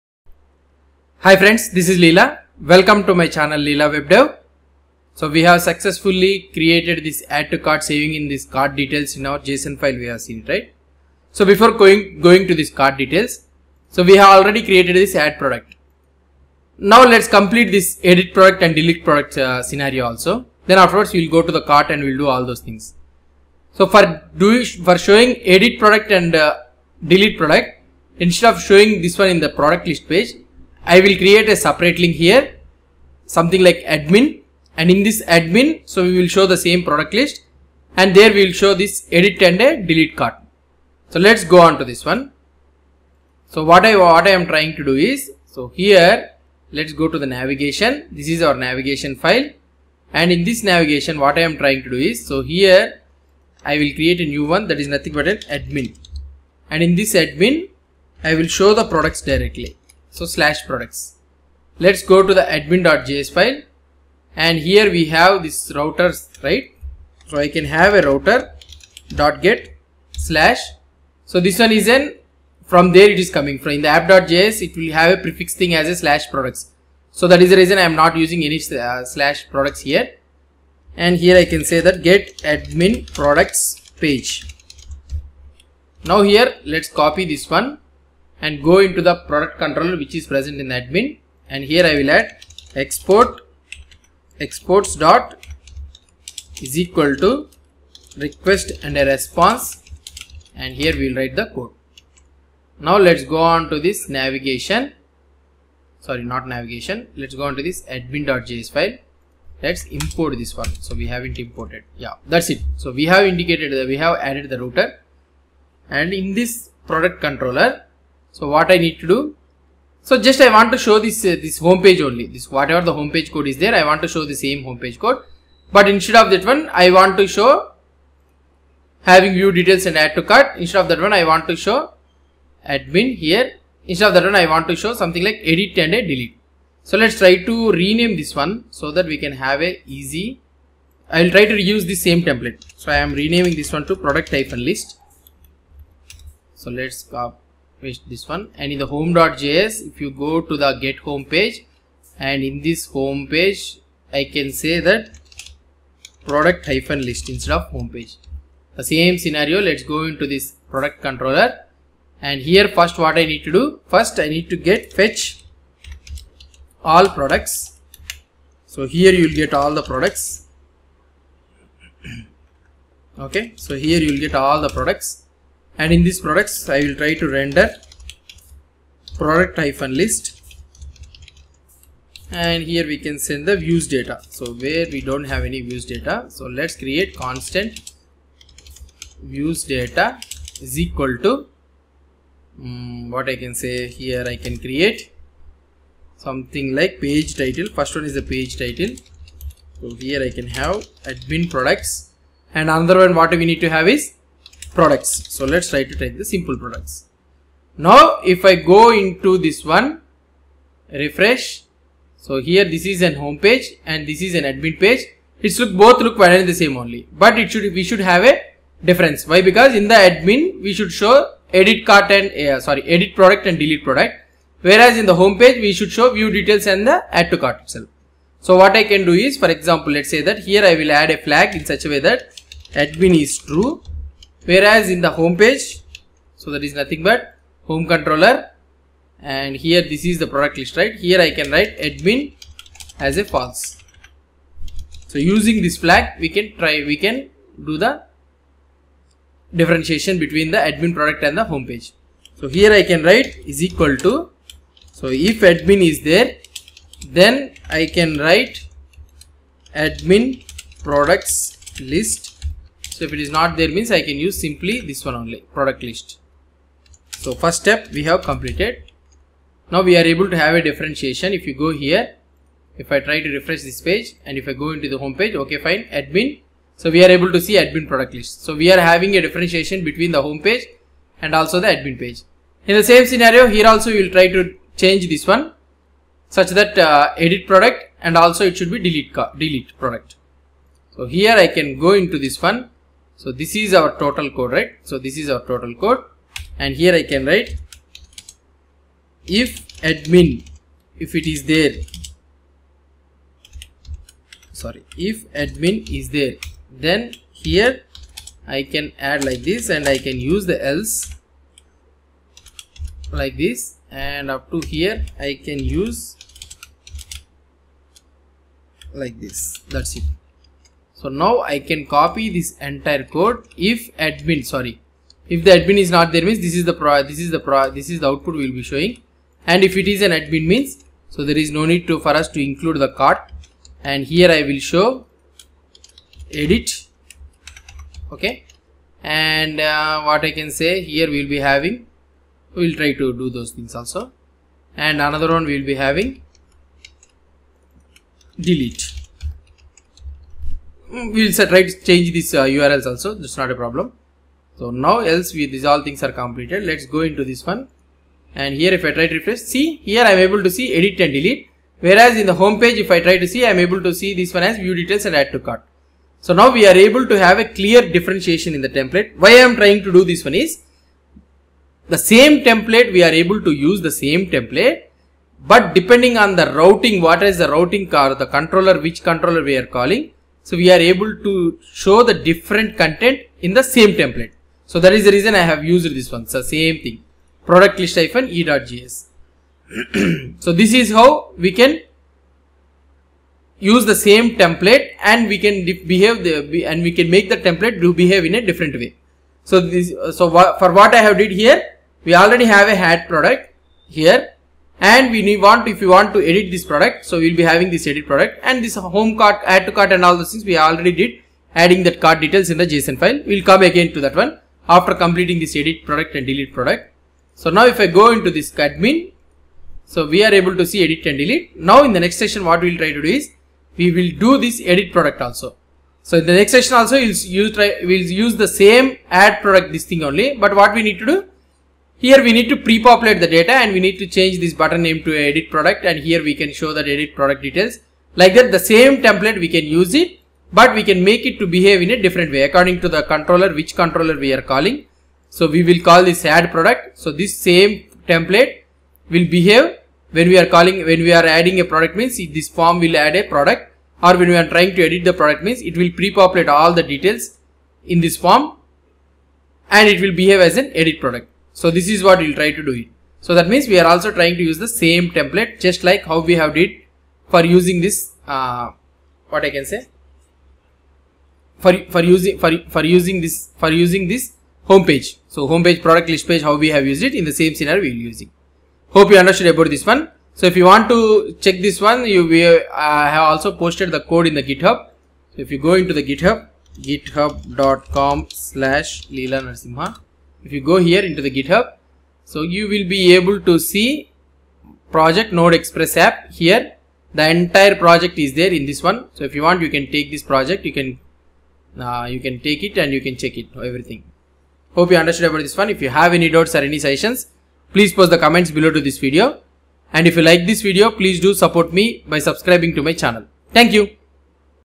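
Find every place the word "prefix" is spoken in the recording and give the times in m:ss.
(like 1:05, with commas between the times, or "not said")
1:15.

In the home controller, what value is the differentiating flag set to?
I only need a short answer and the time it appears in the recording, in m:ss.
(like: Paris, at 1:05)
false, at 4:03.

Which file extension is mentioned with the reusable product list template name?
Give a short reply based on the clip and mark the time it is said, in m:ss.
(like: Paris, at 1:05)
ejs, at 6:28.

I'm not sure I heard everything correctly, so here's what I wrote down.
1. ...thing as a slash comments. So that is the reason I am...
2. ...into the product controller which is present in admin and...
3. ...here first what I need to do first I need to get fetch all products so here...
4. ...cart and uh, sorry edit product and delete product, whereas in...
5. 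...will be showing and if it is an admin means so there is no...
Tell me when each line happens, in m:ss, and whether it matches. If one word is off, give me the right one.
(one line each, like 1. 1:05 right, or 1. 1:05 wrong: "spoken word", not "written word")
1. 1:15 wrong: "products", not "comments"
2. 1:28 right
3. 2:42 right
4. 3:41 right
5. 5:28 right.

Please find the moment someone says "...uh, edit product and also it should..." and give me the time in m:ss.
4:46.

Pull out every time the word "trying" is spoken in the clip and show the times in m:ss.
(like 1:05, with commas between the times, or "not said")
0:44, 0:51, 6:09, 7:34, 7:44.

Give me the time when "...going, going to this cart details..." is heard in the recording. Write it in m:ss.
0:11.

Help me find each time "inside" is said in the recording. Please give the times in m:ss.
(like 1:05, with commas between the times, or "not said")
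not said.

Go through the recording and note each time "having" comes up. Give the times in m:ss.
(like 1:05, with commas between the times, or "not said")
2:09, 4:38, 5:41, 5:45, 6:47.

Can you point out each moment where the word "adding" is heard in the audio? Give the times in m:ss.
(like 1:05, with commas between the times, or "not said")
6:51, 7:31.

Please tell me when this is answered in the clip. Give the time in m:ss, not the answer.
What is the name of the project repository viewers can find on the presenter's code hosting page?
8:15.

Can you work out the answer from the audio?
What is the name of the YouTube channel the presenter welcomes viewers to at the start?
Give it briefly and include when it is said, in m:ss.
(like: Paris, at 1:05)
Leela Web Dev, at 0:03.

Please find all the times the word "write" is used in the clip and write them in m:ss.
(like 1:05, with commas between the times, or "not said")
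1:41, 4:01, 4:13, 4:18, 4:57.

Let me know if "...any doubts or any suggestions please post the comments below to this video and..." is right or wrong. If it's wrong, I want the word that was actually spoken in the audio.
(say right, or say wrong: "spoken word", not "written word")
right.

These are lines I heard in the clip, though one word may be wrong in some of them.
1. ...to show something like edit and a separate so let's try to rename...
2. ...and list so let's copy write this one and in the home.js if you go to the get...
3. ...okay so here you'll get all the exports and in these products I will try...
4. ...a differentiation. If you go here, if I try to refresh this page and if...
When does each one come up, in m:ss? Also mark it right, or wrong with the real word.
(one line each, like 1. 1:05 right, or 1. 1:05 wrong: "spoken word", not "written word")
1. 2:14 wrong: "delete", not "separate"
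2. 2:24 wrong: "paste", not "write"
3. 2:53 wrong: "products", not "exports"
4. 4:30 right.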